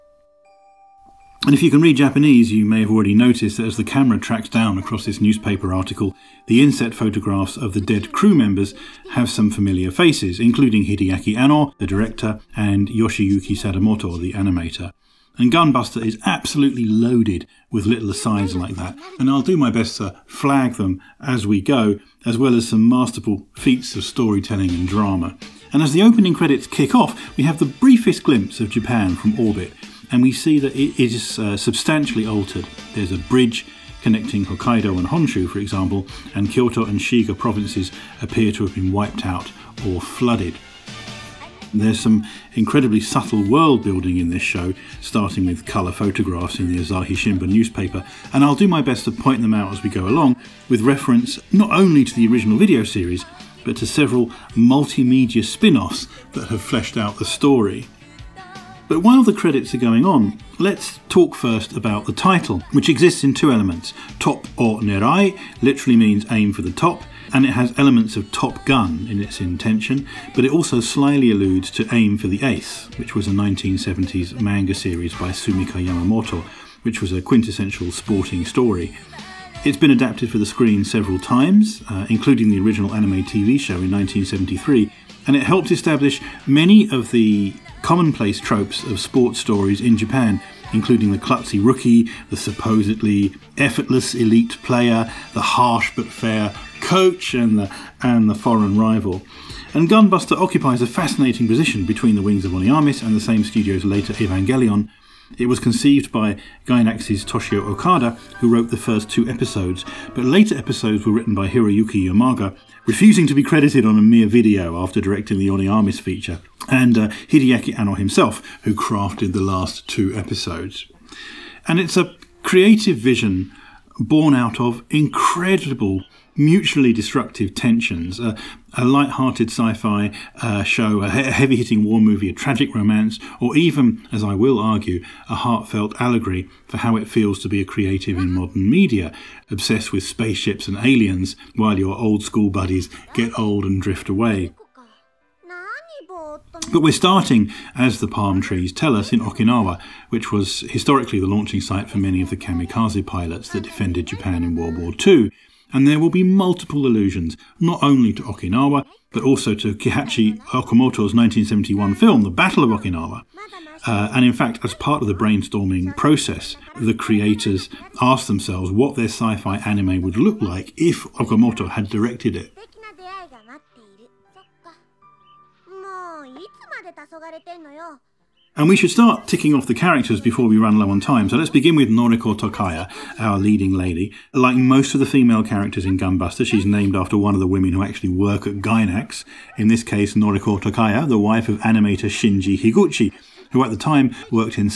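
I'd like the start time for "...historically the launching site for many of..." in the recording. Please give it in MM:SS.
02:30.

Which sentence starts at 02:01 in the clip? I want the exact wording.
And it's a creative vision born out of incredible mutually destructive tensions.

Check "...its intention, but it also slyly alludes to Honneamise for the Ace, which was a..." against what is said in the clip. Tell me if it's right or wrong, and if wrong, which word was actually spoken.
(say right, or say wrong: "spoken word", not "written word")
wrong: "Aim", not "Honneamise".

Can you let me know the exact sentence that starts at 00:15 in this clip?
And Gunbuster is absolutely loaded with little asides like that.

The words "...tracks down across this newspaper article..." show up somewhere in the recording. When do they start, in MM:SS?
00:04.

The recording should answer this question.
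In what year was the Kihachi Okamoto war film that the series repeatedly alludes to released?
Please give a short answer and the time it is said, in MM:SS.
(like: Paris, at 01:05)
1971, at 02:41.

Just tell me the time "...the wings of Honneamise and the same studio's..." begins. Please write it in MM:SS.
01:42.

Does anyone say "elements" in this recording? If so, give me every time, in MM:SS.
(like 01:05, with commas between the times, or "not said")
01:03, 01:07.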